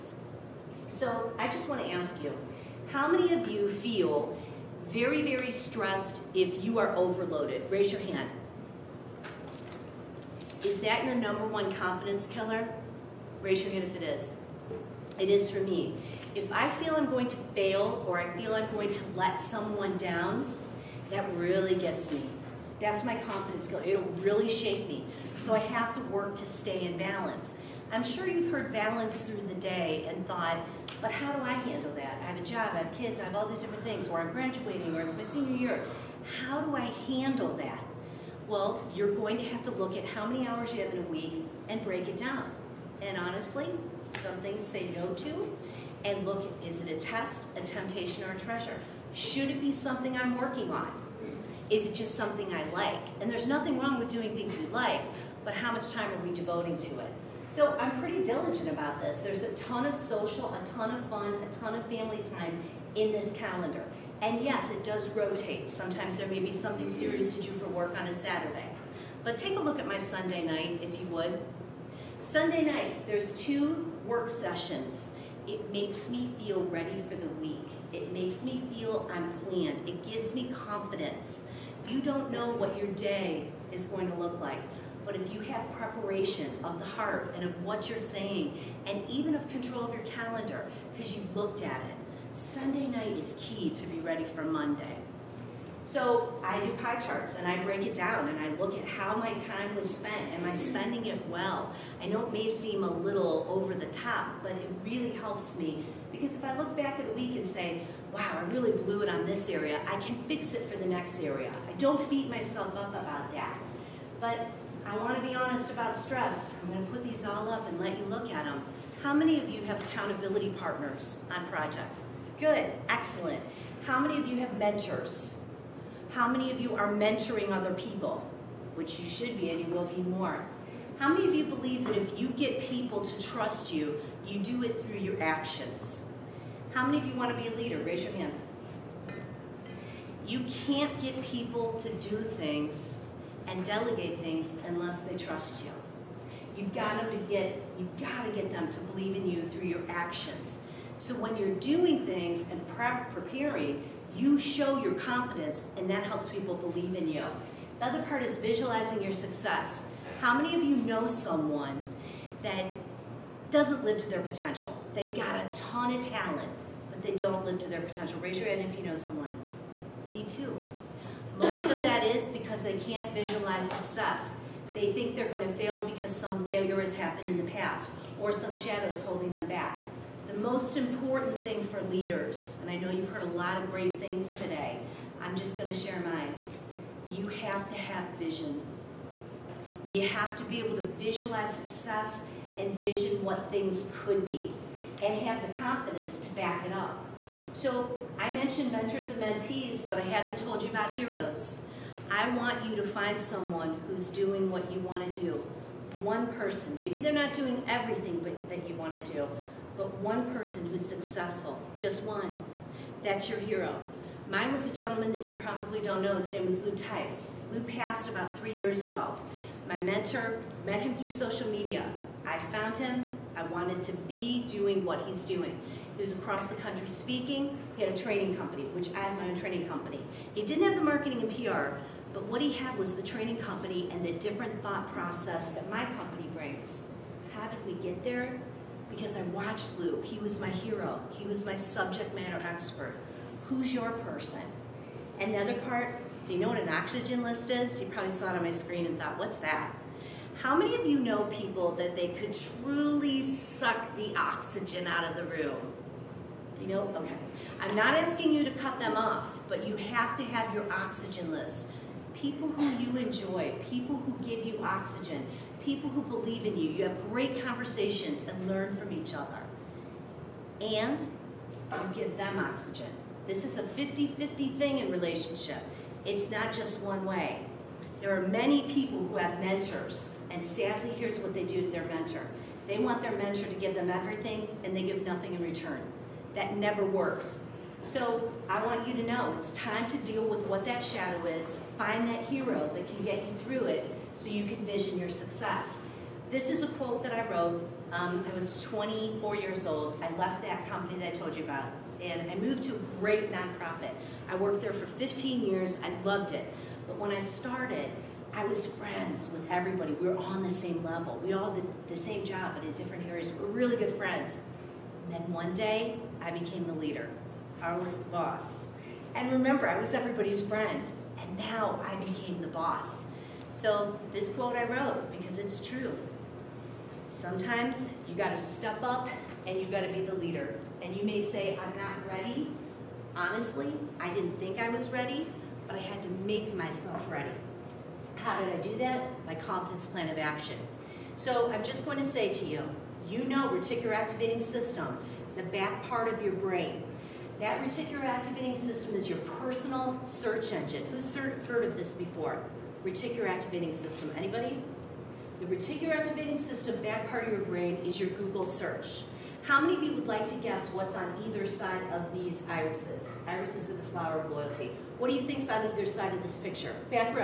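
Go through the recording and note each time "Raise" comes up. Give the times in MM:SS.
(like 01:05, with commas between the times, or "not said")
00:07, 00:13, 02:17, 02:48.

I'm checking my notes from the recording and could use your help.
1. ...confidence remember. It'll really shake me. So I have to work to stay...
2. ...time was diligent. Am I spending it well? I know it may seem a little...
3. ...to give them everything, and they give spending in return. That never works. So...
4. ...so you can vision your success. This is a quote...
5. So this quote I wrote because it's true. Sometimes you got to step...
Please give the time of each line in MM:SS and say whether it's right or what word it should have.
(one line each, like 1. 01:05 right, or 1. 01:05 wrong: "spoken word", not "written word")
1. 00:23 wrong: "killer", not "remember"
2. 01:39 wrong: "spent", not "diligent"
3. 04:43 wrong: "nothing", not "spending"
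4. 04:54 right
5. 05:23 right.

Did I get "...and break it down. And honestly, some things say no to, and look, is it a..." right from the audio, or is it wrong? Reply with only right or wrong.
right.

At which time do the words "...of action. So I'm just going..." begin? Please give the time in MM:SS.
05:40.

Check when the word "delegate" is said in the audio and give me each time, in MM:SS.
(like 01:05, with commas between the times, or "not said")
02:23.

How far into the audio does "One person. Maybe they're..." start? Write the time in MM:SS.
03:26.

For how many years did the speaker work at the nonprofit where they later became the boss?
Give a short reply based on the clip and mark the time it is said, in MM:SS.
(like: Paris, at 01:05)
15, at 05:04.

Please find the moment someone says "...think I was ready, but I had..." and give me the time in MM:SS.
05:34.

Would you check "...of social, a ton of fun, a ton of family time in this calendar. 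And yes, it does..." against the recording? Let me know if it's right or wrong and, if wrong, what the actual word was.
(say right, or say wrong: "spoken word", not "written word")
right.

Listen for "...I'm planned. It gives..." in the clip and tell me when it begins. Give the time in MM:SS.
01:19.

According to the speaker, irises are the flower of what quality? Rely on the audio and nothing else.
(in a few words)
Loyalty.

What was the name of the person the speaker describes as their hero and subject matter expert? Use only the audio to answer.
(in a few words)
Lou Tice.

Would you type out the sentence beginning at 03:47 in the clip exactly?
He had a training company, which I have my own training company.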